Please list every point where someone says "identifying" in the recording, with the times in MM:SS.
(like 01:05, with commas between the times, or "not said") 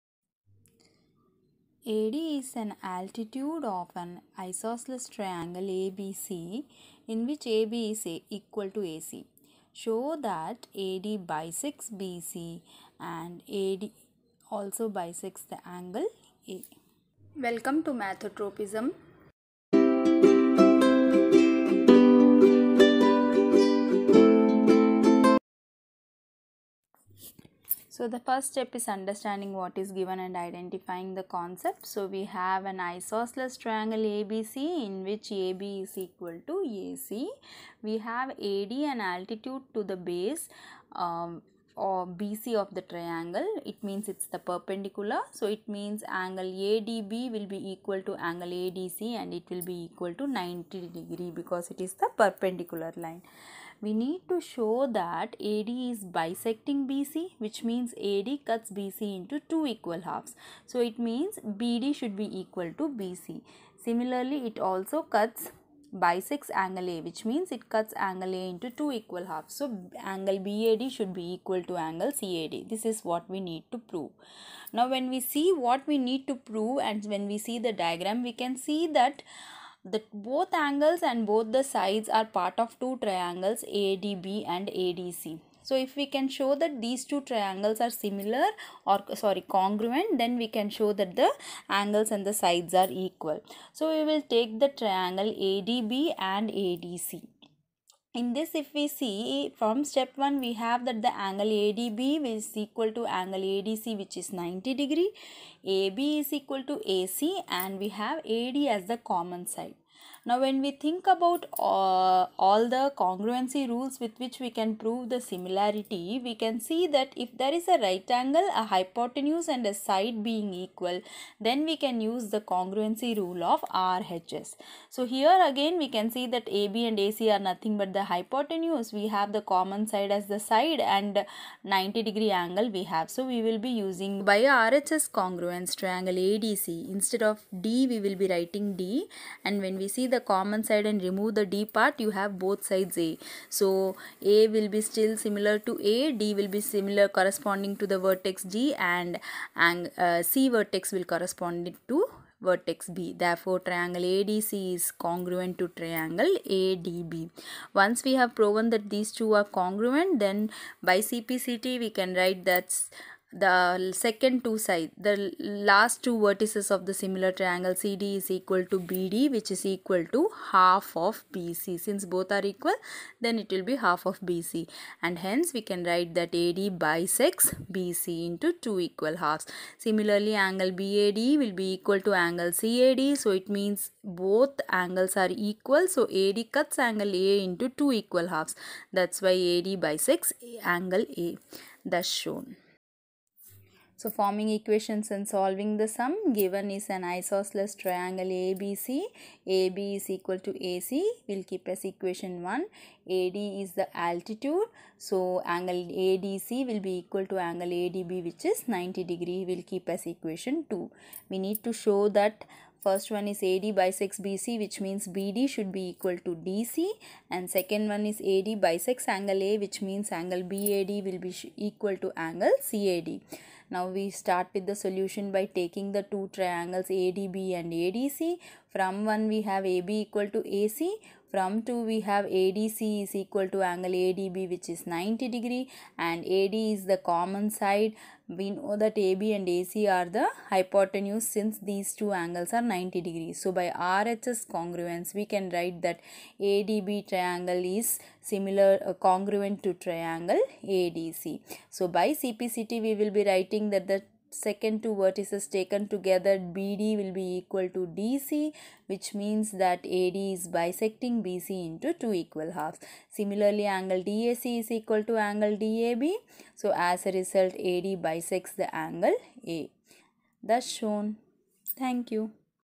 00:30.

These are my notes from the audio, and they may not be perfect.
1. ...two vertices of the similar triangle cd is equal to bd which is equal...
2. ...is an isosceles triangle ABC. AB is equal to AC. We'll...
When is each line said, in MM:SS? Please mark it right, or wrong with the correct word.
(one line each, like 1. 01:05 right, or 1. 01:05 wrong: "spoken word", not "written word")
1. 02:46 right
2. 03:16 right.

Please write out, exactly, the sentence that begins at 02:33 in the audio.
Therefore, triangle ADC is congruent to triangle ADB.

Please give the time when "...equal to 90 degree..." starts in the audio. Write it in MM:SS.
00:49.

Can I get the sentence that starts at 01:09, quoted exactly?
So angle BAD should be equal to angle CAD.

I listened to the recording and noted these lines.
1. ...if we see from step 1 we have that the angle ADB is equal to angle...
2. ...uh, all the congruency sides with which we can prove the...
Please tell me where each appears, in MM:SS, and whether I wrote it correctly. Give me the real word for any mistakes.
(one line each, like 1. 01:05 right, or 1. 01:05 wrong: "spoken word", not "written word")
1. 01:38 right
2. 01:51 wrong: "rules", not "sides".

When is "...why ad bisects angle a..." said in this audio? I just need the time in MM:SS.
03:09.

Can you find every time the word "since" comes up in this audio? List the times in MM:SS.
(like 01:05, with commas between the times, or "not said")
02:51, 04:01.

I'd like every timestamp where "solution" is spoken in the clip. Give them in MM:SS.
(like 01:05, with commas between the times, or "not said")
03:44.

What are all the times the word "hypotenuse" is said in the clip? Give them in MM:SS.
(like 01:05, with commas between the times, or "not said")
01:58, 02:08, 04:00.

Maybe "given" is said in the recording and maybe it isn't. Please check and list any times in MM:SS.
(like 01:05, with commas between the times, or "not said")
00:29, 03:16.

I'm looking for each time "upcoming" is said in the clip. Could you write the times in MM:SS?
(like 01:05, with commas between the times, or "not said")
not said.